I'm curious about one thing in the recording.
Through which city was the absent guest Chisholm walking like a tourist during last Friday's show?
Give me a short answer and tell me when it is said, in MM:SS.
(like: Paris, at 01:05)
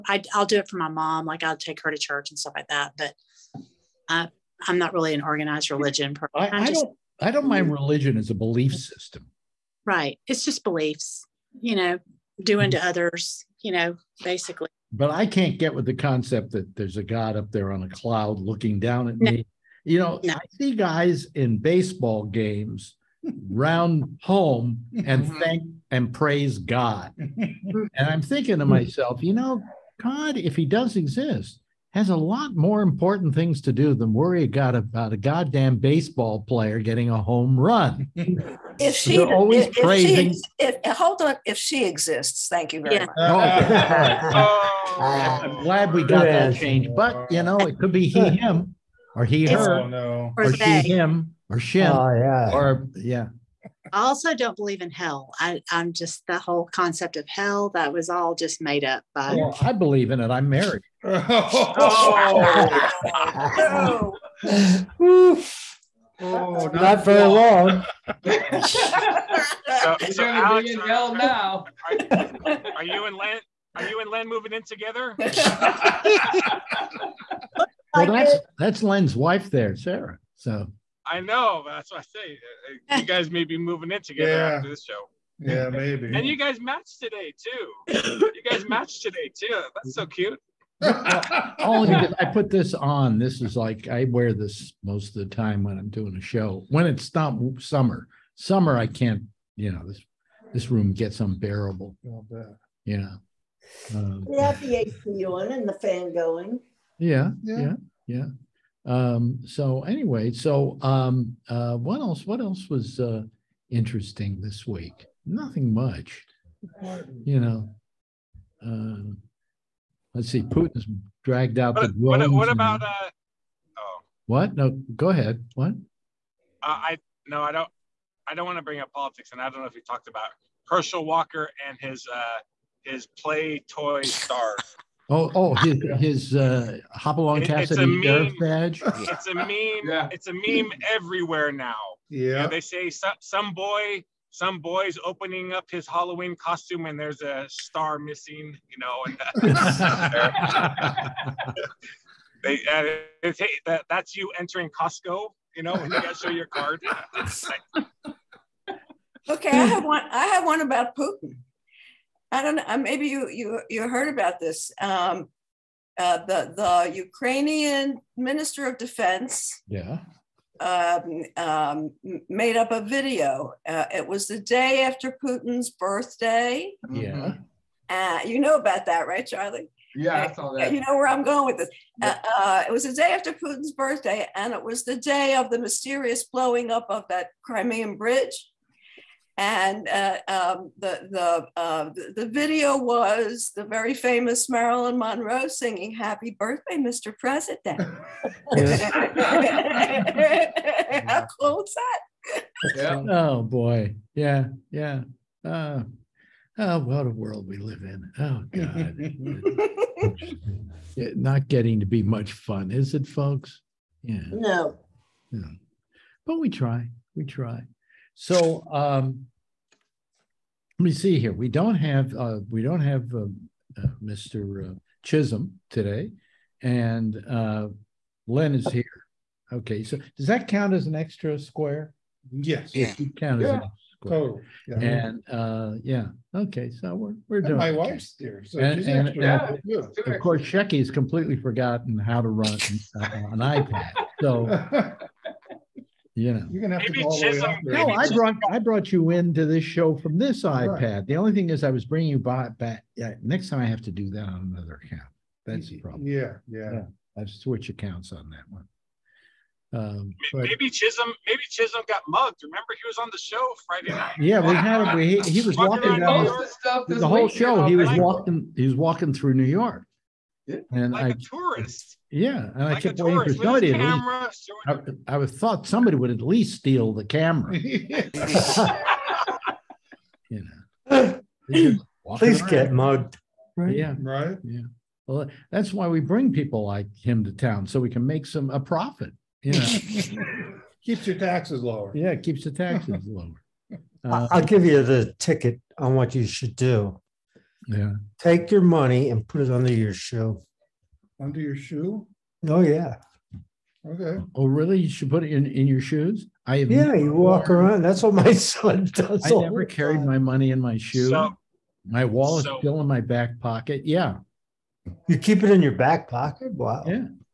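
New York, at 04:29.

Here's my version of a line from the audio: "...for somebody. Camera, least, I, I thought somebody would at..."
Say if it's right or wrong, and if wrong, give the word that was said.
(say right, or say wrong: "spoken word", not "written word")
right.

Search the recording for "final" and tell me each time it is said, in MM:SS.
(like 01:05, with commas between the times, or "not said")
not said.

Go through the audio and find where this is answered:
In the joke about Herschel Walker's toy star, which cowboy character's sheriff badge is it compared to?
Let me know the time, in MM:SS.
02:16.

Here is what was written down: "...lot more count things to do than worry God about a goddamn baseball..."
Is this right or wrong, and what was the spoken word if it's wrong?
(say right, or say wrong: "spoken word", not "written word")
wrong: "important", not "count".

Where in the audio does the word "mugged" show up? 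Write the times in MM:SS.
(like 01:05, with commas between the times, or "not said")
04:22, 04:42.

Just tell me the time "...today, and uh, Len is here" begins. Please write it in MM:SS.
03:45.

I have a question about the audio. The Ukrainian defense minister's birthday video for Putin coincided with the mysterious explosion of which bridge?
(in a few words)
Crimean bridge.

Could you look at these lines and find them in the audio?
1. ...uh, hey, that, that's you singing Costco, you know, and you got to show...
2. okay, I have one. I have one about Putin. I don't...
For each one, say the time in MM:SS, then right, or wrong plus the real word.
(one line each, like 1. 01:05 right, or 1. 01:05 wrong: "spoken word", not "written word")
1. 02:32 wrong: "entering", not "singing"
2. 02:39 right.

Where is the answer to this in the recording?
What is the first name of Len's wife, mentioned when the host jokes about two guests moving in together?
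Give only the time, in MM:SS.
01:19.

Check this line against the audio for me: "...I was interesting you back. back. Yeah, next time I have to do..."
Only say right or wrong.
wrong.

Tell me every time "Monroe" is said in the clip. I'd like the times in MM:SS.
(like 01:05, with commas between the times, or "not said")
03:14.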